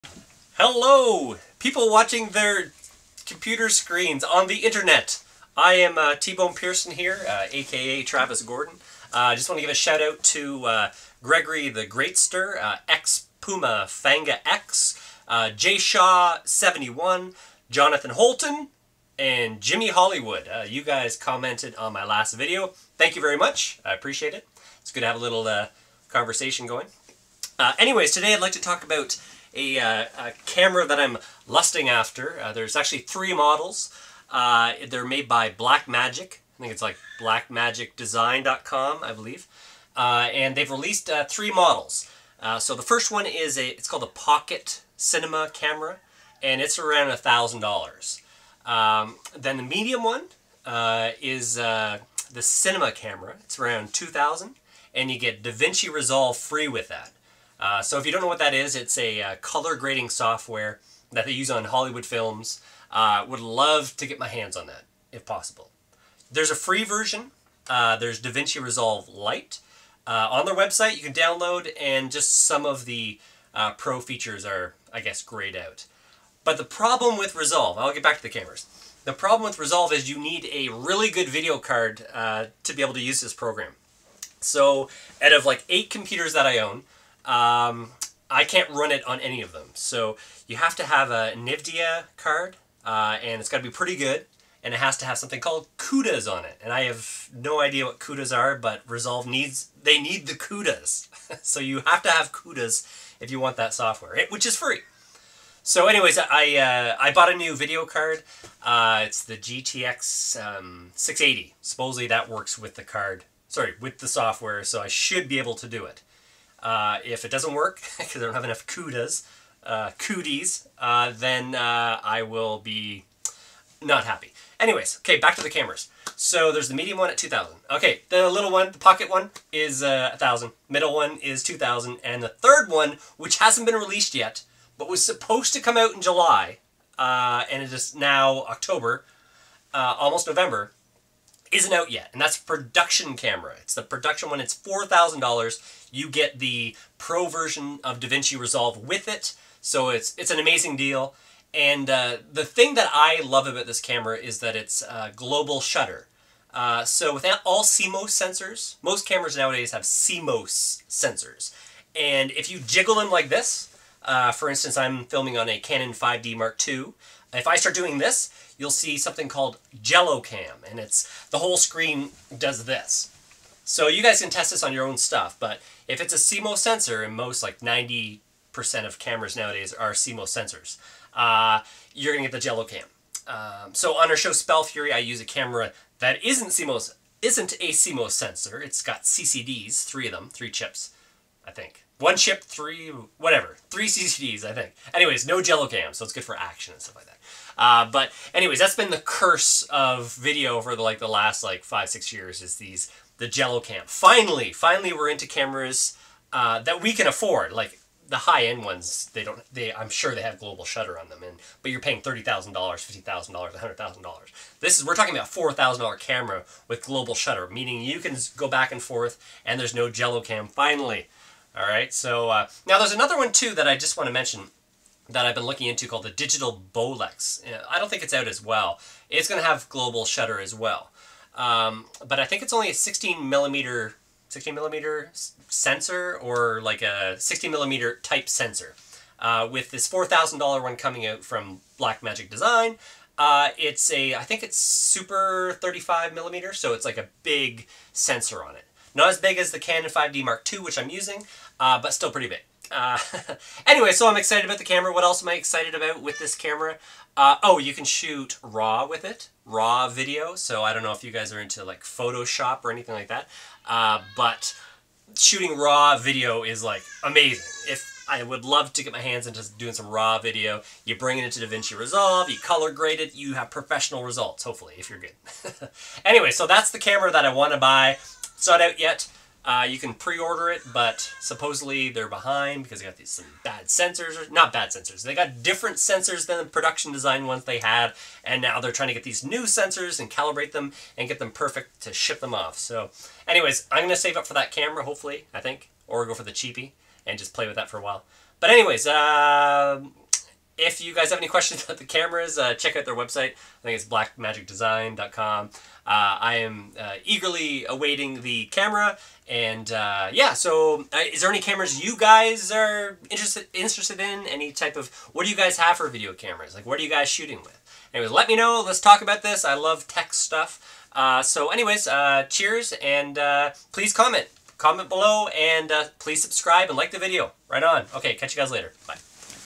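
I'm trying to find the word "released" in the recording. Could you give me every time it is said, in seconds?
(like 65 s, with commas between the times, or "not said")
40 s, 133 s.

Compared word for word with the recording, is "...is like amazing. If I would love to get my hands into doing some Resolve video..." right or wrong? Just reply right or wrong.
wrong.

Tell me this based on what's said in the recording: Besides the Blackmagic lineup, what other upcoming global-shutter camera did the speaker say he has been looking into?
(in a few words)
Digital Bolex.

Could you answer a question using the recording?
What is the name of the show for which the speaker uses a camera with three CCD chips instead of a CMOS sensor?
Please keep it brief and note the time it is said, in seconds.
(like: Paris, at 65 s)
Spell Fury, at 184 s.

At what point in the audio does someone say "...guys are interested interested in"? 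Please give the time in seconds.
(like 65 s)
311 s.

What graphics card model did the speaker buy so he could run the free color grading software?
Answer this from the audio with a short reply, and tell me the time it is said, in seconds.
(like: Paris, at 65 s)
GTX 680, at 109 s.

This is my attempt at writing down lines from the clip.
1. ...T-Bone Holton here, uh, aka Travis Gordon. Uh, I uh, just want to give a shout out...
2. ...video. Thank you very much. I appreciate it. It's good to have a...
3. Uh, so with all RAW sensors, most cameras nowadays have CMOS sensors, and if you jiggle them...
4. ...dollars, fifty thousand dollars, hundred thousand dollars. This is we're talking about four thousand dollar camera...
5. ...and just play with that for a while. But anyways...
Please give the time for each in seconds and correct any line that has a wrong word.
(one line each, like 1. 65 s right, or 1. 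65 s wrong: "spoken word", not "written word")
1. 6 s wrong: "Pearson", not "Holton"
2. 22 s right
3. 156 s wrong: "CMOS", not "RAW"
4. 212 s right
5. 297 s right.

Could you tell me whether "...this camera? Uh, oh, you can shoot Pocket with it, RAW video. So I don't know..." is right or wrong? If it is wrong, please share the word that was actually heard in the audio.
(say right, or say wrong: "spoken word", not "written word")
wrong: "RAW", not "Pocket".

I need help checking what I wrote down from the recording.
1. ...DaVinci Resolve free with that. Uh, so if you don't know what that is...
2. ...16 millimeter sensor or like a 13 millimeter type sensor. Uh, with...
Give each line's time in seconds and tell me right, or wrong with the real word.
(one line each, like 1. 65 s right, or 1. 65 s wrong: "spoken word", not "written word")
1. 55 s right
2. 234 s wrong: "16", not "13".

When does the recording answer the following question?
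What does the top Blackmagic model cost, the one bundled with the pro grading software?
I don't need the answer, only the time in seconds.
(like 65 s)
144 s.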